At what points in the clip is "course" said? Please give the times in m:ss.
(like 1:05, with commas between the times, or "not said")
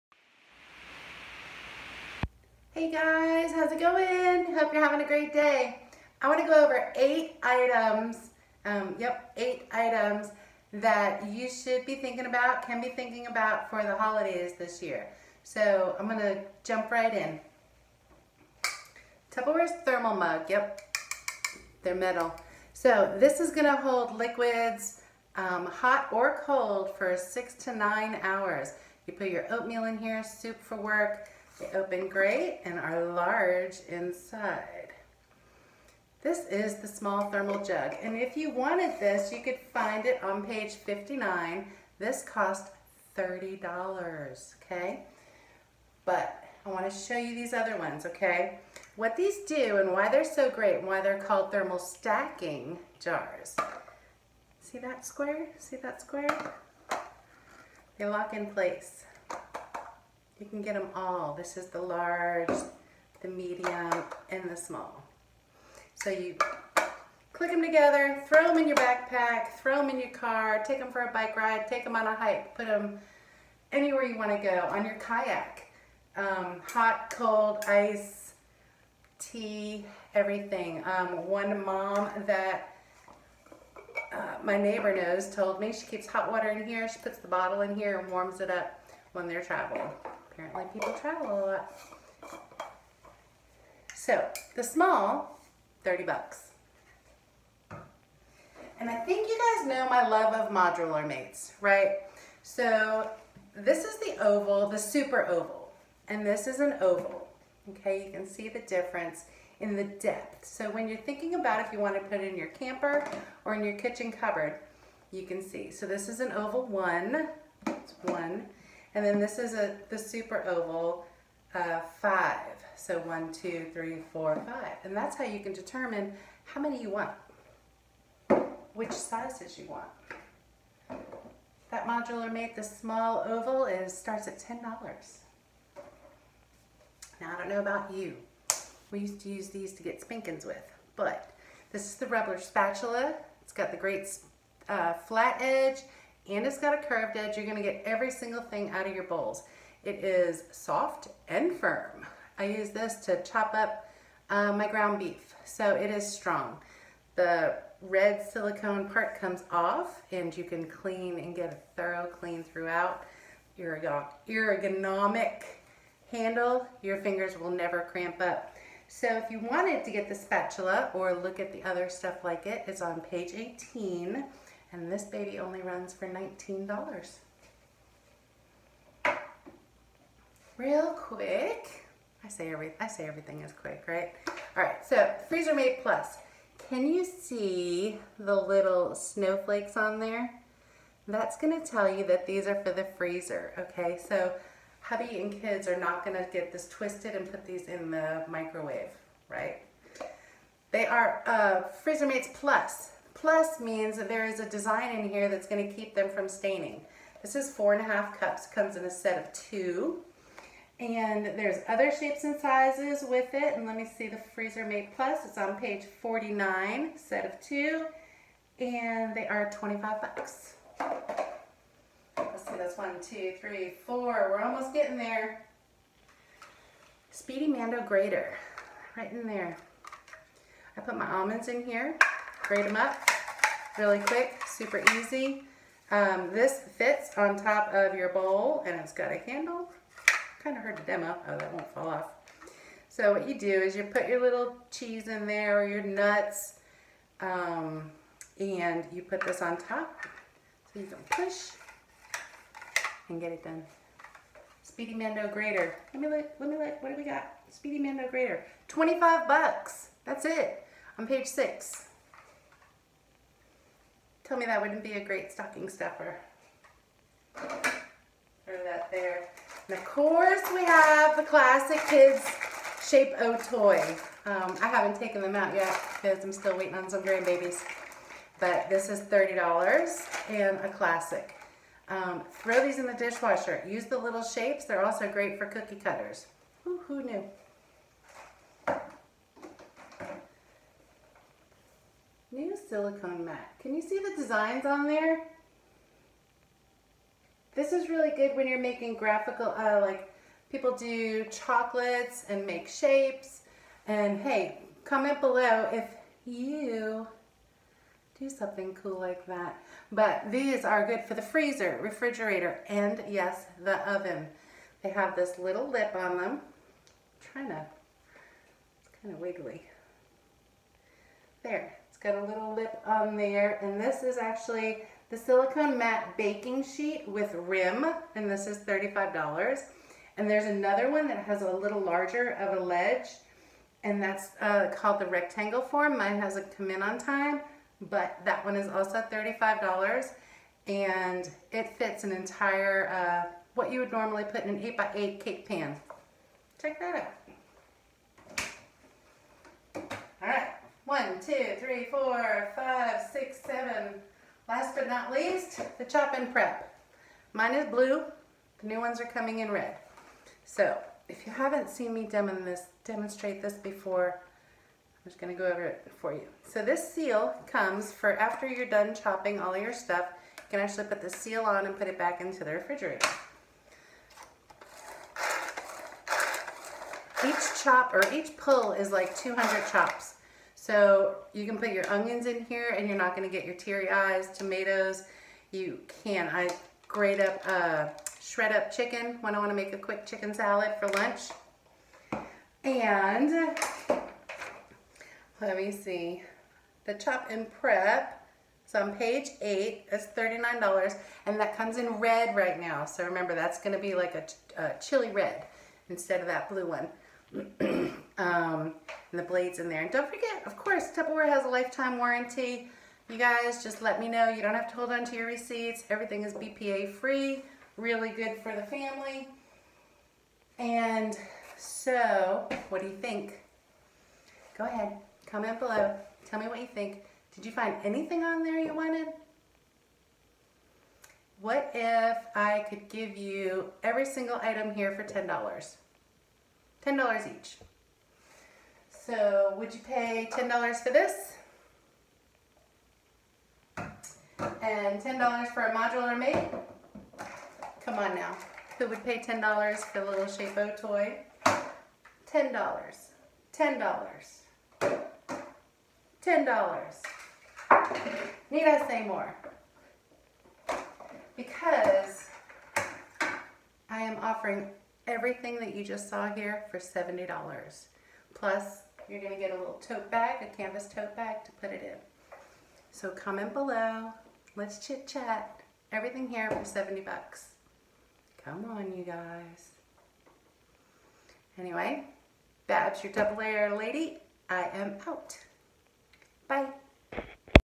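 4:29, 6:50.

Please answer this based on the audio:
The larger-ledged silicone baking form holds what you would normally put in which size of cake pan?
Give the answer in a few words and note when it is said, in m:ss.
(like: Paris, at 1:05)
8x8, at 5:44.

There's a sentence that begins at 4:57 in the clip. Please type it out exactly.
This is really good when you're making graphical, uh, like people do chocolates and make shapes.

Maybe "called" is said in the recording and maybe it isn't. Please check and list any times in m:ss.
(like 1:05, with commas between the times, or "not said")
0:51, 5:34.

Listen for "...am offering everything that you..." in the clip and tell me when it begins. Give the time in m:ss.
7:44.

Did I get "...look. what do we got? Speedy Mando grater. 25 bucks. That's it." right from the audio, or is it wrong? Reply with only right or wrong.
right.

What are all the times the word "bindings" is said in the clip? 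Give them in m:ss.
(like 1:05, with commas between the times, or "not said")
not said.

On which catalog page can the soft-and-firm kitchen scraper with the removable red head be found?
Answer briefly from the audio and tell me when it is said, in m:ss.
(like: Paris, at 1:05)
page 18, at 2:53.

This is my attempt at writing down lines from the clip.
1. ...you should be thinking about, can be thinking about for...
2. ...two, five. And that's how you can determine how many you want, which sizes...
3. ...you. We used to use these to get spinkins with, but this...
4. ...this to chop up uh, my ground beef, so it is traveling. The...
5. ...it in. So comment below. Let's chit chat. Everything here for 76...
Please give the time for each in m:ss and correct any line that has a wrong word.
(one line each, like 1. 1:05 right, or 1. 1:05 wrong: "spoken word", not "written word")
1. 0:11 right
2. 2:04 wrong: "four", not "two"
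3. 2:17 right
4. 2:32 wrong: "strong", not "traveling"
5. 7:51 wrong: "70", not "76".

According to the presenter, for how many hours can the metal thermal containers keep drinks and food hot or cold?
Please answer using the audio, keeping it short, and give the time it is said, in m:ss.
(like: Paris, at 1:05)
6 to 9 hours, at 0:27.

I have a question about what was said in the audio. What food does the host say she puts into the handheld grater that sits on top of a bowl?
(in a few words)
almonds.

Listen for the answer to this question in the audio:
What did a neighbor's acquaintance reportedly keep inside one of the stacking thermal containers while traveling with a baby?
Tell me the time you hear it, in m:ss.
1:26.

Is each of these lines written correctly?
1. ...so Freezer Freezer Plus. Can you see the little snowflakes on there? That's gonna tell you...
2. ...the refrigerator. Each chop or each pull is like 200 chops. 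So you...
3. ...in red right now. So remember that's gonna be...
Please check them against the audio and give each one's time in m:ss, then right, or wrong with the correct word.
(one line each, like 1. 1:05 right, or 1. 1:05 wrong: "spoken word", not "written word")
1. 3:04 wrong: "Mates", not "Freezer"
2. 6:12 right
3. 6:41 right.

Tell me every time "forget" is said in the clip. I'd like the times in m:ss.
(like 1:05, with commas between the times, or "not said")
6:50.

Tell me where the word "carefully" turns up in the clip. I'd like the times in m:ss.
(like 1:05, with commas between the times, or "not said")
not said.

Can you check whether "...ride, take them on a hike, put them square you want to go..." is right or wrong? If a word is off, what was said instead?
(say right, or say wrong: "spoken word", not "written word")
wrong: "anywhere", not "square".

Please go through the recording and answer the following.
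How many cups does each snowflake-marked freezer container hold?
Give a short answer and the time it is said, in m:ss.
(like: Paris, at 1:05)
4.5 cups, at 3:27.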